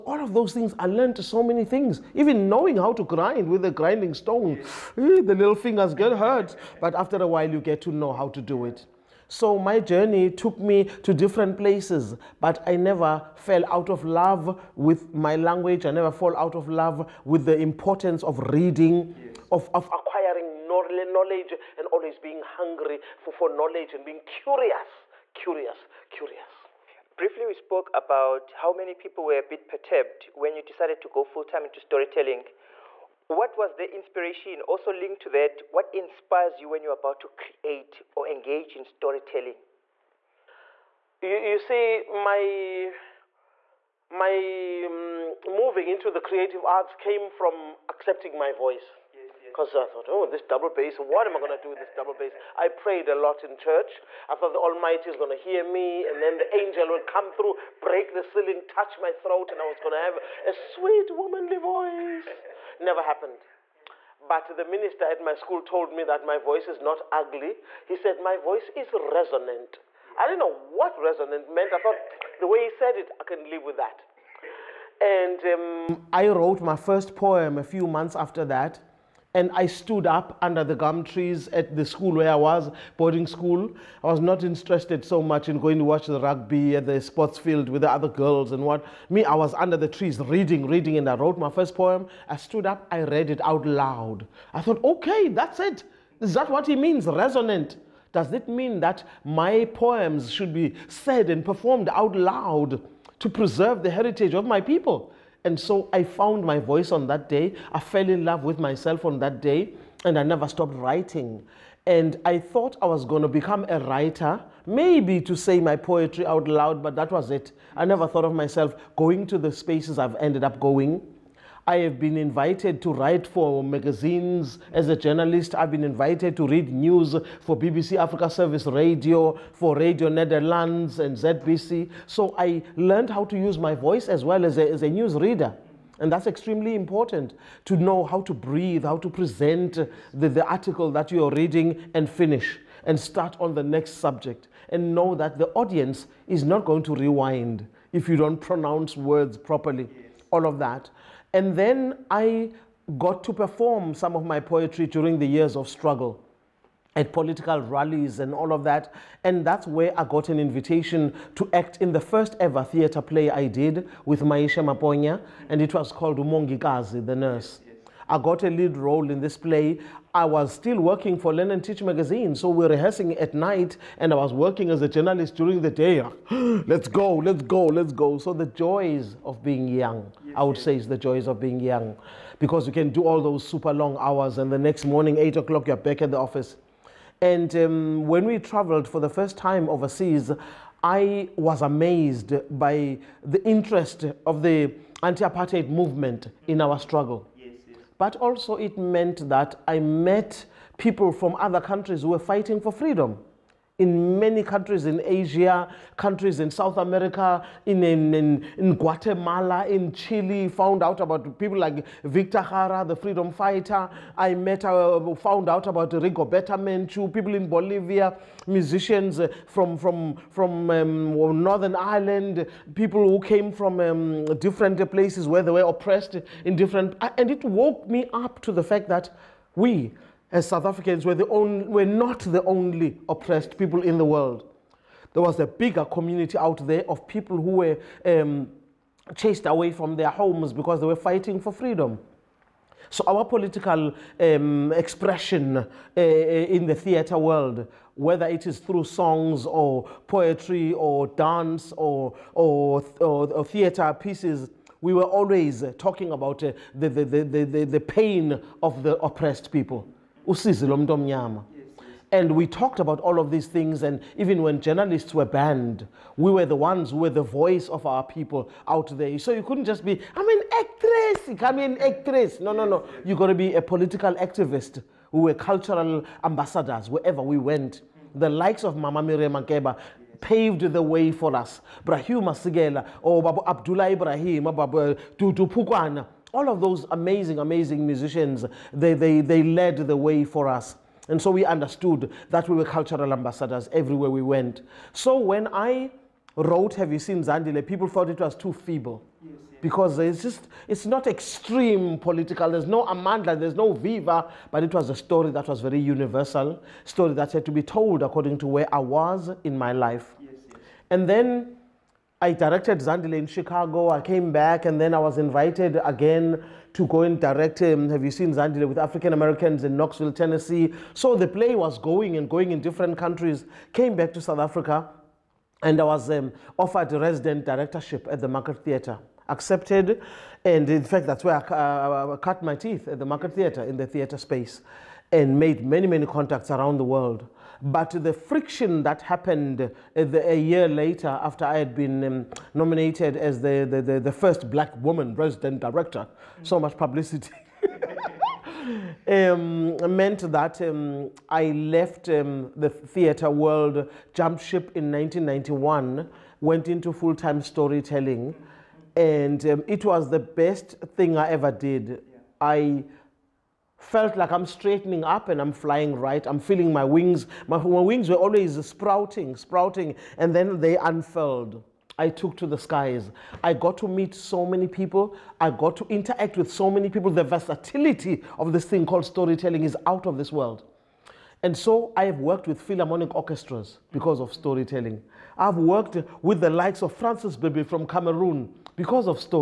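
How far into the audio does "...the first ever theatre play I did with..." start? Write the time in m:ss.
2:41.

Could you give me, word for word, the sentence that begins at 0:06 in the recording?
But after a while, you get to know how to do it.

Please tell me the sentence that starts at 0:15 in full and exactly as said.
I never fall out of love with the importance of reading, yes.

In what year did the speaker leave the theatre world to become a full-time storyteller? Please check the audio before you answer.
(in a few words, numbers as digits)
1991.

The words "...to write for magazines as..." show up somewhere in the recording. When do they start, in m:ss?
2:02.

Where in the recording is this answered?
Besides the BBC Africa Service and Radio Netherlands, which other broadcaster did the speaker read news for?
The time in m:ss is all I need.
2:11.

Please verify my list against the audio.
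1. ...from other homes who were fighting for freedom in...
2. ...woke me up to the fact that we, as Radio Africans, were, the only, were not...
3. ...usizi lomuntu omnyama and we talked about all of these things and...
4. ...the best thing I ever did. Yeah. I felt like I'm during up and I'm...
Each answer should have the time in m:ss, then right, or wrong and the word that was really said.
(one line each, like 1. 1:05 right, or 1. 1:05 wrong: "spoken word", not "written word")
1. 3:21 wrong: "countries", not "homes"
2. 3:47 wrong: "South", not "Radio"
3. 4:20 right
4. 6:00 wrong: "straightening", not "during".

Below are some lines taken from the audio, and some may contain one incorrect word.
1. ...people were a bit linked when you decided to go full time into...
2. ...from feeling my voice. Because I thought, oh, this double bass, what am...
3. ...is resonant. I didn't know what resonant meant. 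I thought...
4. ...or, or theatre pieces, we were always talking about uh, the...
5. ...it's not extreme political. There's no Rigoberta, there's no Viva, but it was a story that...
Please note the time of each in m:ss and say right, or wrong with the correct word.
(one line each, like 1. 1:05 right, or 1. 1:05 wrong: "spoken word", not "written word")
1. 0:28 wrong: "perturbed", not "linked"
2. 0:47 wrong: "accepting", not "feeling"
3. 1:08 right
4. 4:12 right
5. 5:00 wrong: "Amanda", not "Rigoberta".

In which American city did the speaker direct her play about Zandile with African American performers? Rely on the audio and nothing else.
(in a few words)
Knoxville, Tennessee.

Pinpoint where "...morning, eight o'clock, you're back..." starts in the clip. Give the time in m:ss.
3:04.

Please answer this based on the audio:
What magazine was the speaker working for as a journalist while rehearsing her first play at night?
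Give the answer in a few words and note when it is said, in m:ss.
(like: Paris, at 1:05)
Learn and Teach, at 2:51.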